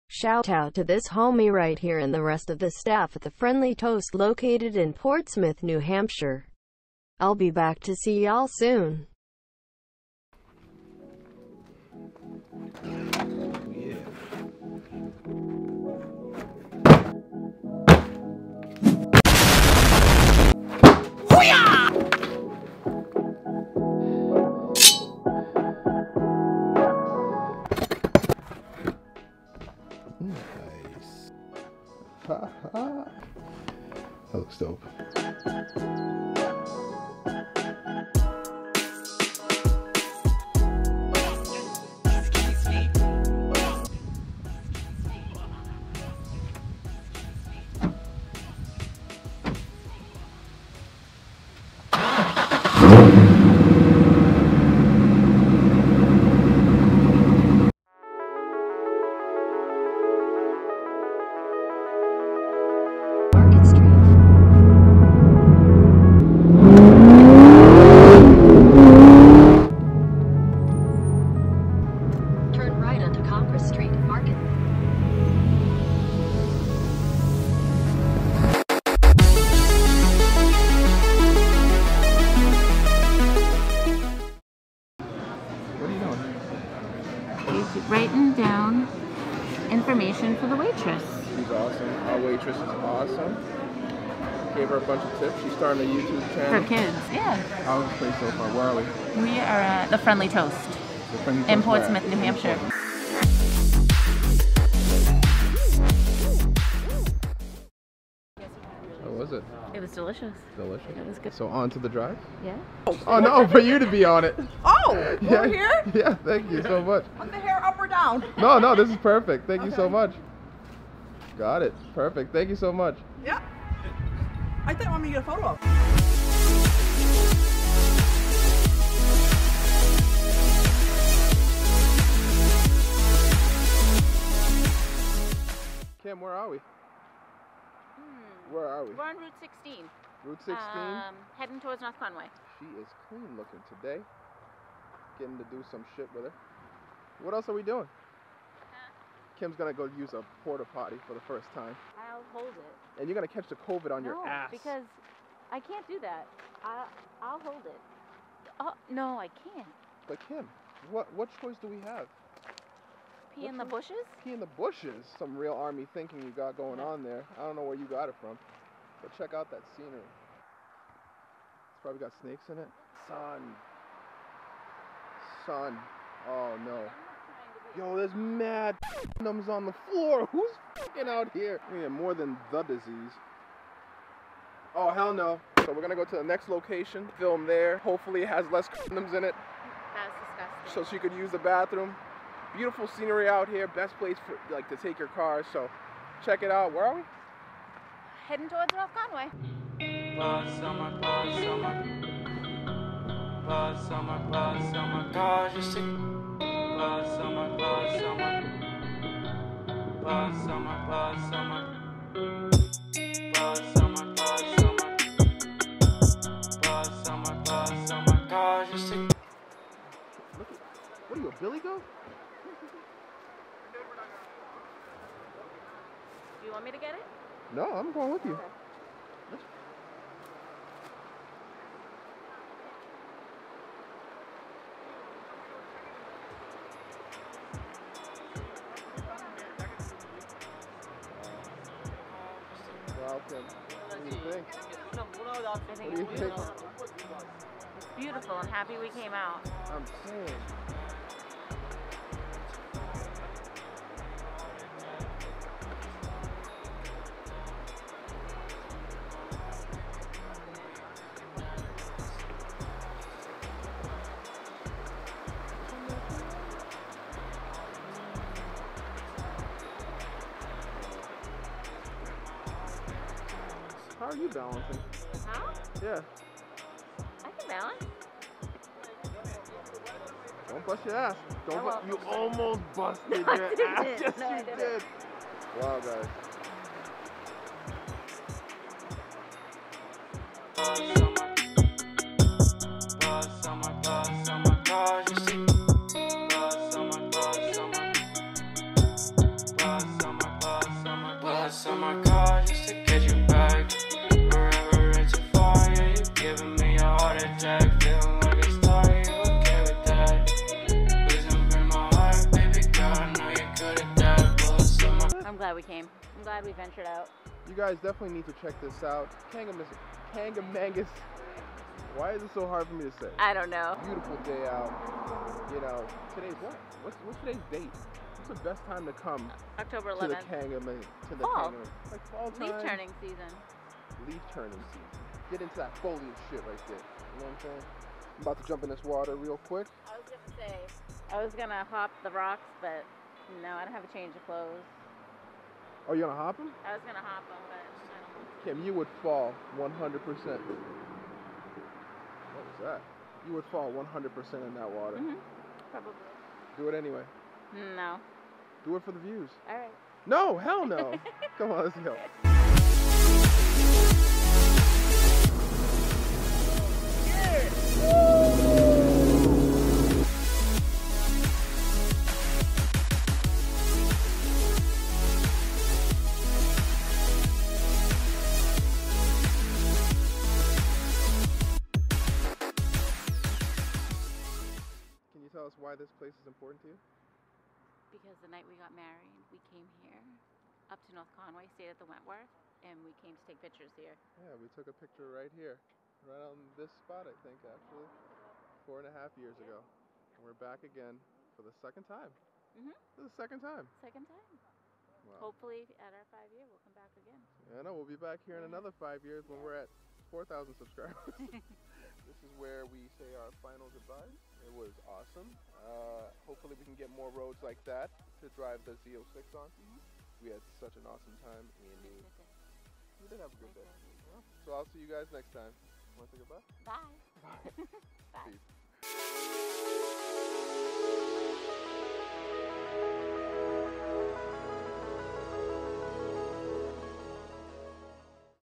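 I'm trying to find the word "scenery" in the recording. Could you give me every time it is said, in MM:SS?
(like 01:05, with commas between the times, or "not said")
02:49, 03:12.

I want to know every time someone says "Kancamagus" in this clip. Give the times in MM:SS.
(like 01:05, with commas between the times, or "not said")
05:19, 05:30.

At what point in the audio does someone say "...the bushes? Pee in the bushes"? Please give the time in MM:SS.
02:43.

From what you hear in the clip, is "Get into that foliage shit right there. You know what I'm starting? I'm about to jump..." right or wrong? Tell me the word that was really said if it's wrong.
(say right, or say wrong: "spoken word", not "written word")
wrong: "saying", not "starting".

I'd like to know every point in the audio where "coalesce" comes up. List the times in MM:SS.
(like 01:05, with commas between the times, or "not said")
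not said.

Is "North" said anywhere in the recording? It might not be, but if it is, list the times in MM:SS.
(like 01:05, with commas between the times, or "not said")
02:21, 06:30.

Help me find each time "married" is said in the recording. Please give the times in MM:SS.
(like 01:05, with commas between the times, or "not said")
06:28.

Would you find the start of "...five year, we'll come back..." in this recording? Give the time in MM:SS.
06:46.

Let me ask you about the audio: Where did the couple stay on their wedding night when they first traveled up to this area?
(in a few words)
The Wentworth.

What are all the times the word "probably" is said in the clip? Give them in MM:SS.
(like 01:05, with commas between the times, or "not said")
02:51, 05:55.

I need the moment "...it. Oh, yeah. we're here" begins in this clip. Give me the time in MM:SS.
01:54.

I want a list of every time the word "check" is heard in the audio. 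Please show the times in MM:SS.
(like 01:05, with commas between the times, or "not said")
02:49, 03:16, 05:18.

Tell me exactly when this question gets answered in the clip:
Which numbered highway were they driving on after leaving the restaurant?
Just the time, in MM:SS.
02:18.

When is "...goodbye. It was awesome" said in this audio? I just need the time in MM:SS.
06:53.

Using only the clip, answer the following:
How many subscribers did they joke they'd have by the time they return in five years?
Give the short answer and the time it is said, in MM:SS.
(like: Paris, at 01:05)
4,000, at 06:50.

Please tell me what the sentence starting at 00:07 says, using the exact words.
I'll be back to see y'all soon.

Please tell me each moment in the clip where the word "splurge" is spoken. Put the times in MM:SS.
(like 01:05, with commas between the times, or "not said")
not said.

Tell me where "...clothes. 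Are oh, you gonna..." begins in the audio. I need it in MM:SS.
05:44.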